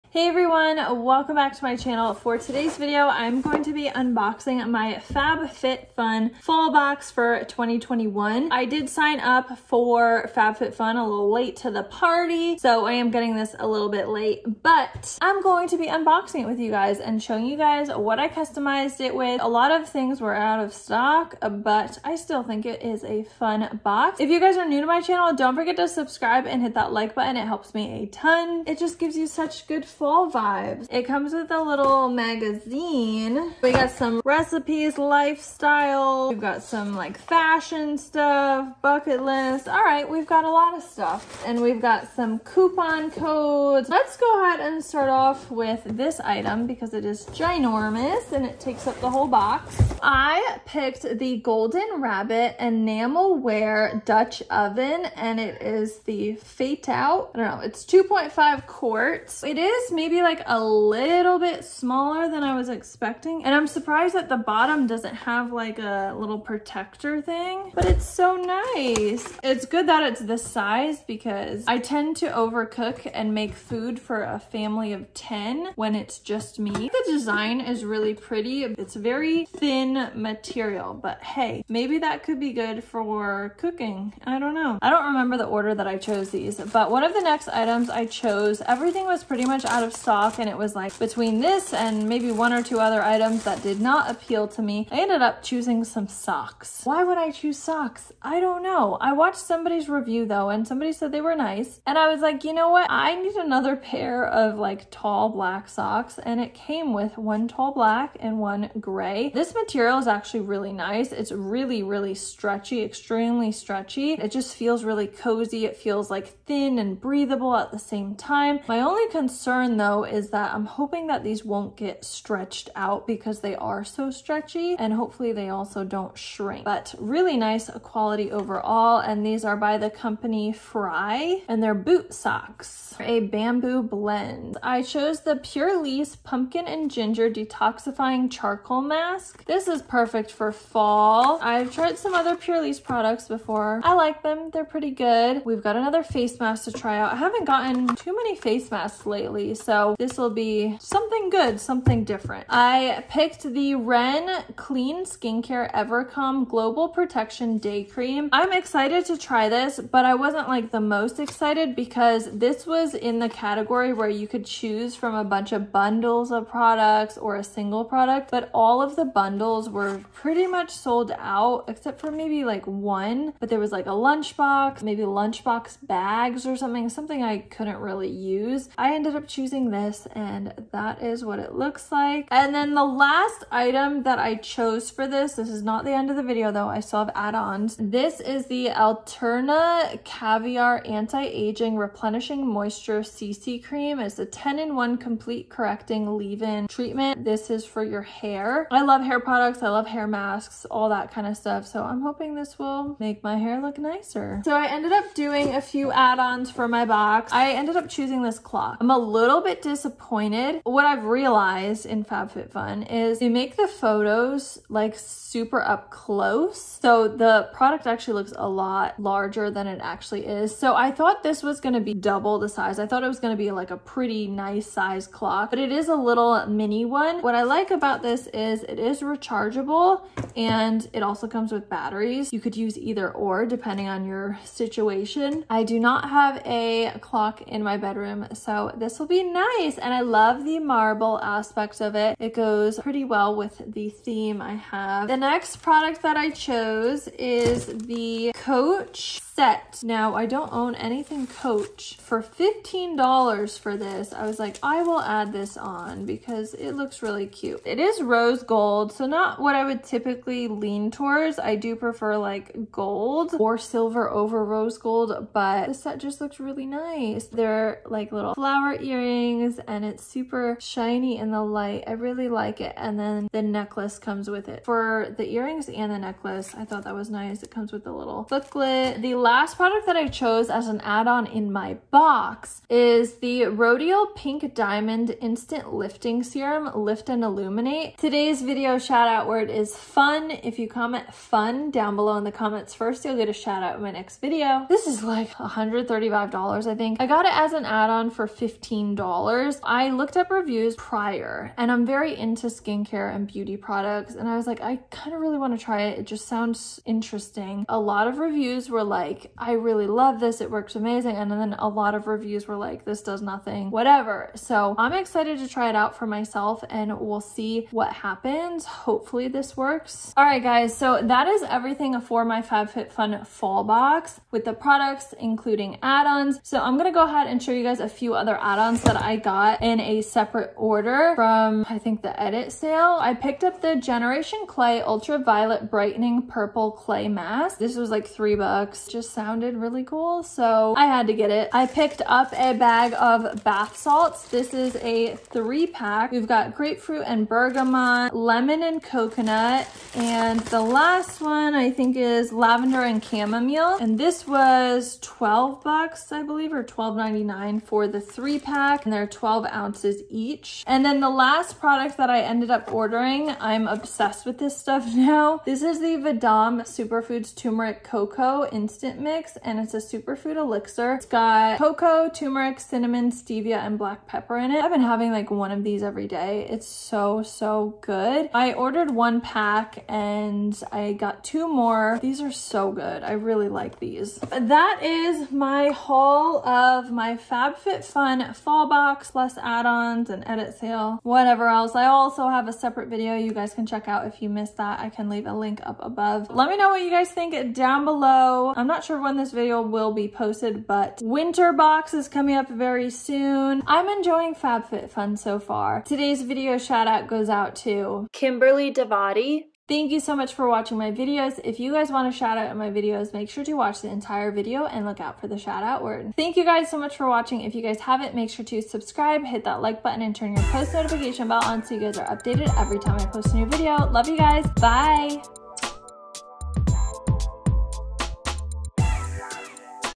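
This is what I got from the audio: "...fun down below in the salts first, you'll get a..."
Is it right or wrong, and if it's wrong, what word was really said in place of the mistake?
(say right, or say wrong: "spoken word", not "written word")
wrong: "comments", not "salts".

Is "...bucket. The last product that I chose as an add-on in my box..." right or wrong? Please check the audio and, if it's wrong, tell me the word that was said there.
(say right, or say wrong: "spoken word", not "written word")
wrong: "booklet", not "bucket".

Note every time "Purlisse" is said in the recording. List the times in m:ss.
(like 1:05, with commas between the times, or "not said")
2:15, 2:22.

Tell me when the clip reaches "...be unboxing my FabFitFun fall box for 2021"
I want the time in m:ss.
0:03.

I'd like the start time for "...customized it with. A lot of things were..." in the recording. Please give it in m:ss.
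0:18.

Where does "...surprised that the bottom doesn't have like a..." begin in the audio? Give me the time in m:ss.
1:03.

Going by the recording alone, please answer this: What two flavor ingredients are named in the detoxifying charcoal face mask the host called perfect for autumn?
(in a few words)
Pumpkin and Ginger.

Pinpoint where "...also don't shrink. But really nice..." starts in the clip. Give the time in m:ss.
2:05.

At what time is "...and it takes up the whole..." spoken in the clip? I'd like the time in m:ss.
0:48.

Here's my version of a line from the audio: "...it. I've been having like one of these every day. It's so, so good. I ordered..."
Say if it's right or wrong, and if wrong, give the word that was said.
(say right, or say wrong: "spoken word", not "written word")
right.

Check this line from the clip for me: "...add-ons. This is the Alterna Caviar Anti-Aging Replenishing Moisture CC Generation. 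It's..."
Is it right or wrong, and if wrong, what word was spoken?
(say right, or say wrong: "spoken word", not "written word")
wrong: "Cream", not "Generation".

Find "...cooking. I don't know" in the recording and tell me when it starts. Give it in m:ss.
1:23.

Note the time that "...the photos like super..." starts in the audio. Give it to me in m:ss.
3:33.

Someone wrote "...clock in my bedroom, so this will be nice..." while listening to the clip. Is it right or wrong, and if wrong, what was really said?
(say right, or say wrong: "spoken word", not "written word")
right.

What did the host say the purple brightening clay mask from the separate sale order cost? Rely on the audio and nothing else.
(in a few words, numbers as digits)
3 dollars.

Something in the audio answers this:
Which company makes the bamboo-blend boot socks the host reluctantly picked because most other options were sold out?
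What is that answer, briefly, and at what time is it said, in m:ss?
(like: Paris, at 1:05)
Fry, at 2:10.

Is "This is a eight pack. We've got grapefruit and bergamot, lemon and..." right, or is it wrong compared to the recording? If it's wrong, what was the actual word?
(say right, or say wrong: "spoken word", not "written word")
wrong: "three", not "eight".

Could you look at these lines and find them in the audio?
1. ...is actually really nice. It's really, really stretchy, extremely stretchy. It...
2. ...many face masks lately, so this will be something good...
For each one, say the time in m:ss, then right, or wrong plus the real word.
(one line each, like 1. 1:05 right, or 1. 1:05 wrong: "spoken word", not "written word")
1. 1:49 right
2. 2:28 right.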